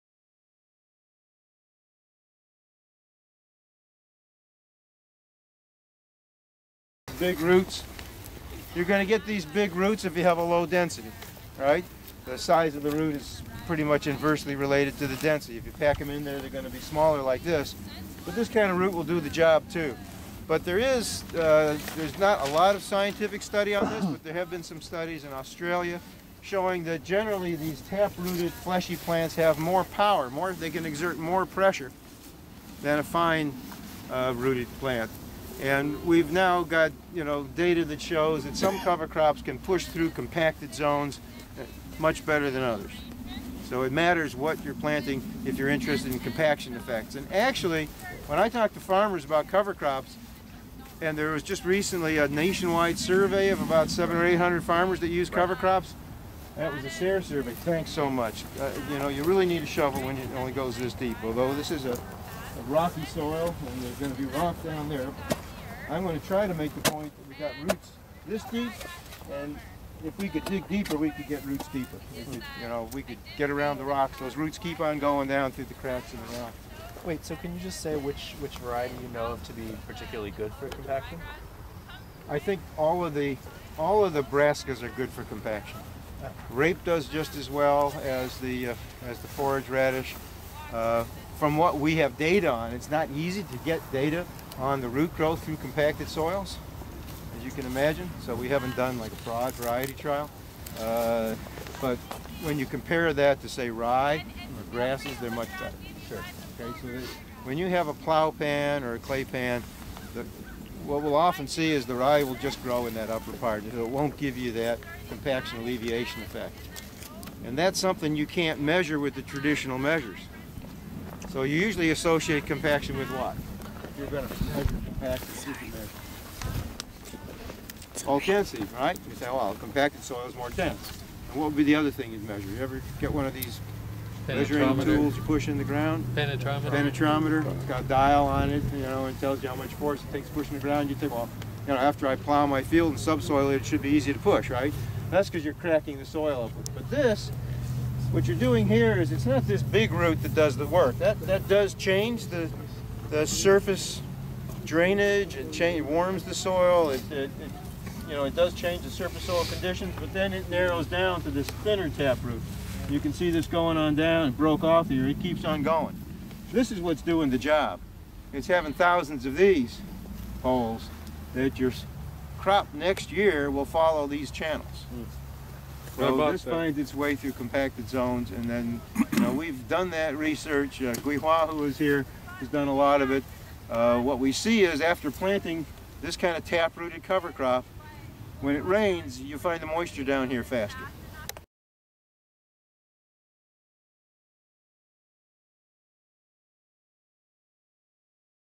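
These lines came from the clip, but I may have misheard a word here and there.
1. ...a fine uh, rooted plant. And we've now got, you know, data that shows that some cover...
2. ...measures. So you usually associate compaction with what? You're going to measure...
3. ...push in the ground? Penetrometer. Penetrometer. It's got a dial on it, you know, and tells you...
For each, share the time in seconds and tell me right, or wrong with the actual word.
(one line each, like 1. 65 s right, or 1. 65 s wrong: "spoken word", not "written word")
1. 32 s right
2. 119 s right
3. 135 s right.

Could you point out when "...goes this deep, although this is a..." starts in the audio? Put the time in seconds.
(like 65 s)
60 s.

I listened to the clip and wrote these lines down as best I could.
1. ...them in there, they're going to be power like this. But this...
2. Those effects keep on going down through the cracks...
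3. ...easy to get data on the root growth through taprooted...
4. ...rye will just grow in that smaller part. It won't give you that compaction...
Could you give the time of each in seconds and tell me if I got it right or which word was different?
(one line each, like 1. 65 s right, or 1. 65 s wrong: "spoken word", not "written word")
1. 15 s wrong: "smaller", not "power"
2. 74 s wrong: "roots", not "effects"
3. 93 s wrong: "compacted", not "taprooted"
4. 111 s wrong: "upper", not "smaller".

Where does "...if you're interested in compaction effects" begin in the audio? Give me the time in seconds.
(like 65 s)
45 s.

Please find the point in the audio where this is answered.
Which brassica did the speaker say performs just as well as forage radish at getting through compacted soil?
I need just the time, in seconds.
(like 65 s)
86 s.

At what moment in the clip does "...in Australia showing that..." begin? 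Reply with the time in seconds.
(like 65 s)
25 s.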